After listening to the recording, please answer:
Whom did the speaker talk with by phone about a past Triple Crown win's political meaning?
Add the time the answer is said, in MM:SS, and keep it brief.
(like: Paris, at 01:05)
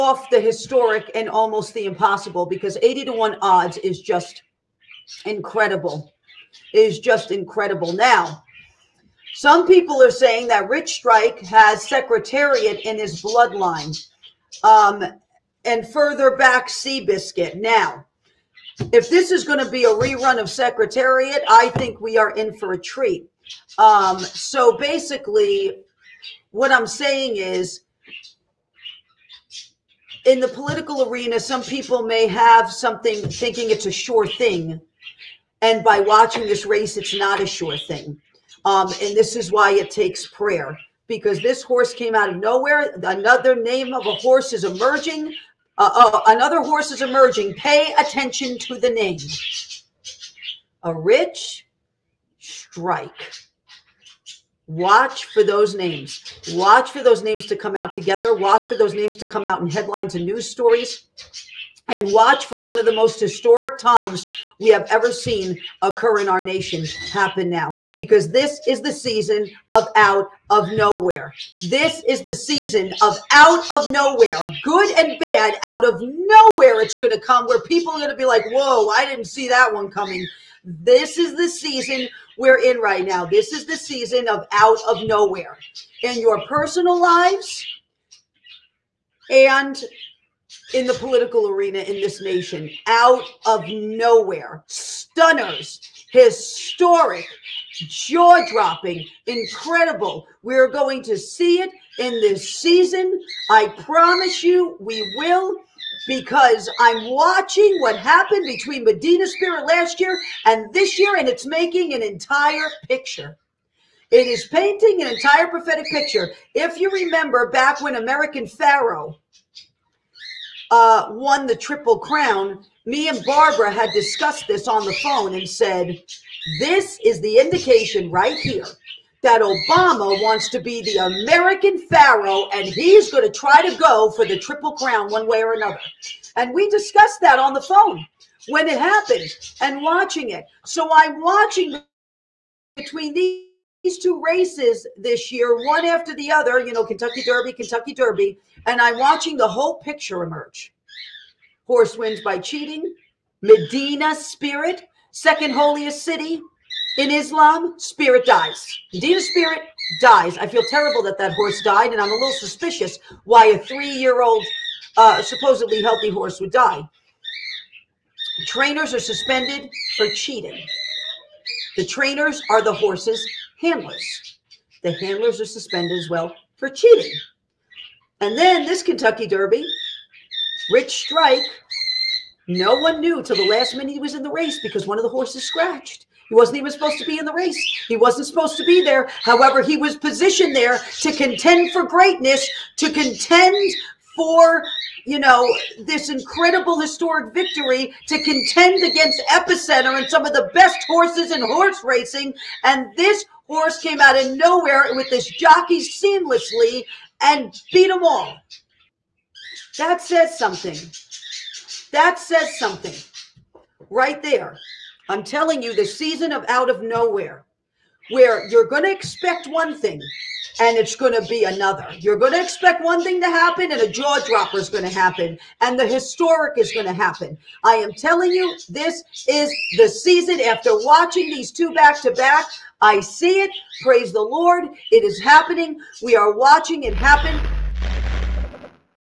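Barbara, at 02:03.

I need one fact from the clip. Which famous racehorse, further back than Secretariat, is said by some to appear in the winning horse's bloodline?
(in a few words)
Seabiscuit.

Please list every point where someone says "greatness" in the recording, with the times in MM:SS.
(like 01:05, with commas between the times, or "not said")
03:11.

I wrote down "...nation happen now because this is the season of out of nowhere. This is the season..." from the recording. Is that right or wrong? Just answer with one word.
right.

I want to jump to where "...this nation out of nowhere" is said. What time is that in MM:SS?
01:32.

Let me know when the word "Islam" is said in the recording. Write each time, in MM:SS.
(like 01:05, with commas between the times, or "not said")
02:37.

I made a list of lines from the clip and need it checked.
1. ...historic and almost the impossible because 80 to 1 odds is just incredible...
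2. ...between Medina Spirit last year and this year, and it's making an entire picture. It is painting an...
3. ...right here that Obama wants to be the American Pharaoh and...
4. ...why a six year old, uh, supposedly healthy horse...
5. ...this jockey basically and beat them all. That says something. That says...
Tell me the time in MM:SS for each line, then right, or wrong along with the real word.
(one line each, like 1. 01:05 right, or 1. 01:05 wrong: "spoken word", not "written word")
1. 00:00 right
2. 01:48 right
3. 02:08 right
4. 02:43 wrong: "three", not "six"
5. 03:25 wrong: "seamlessly", not "basically".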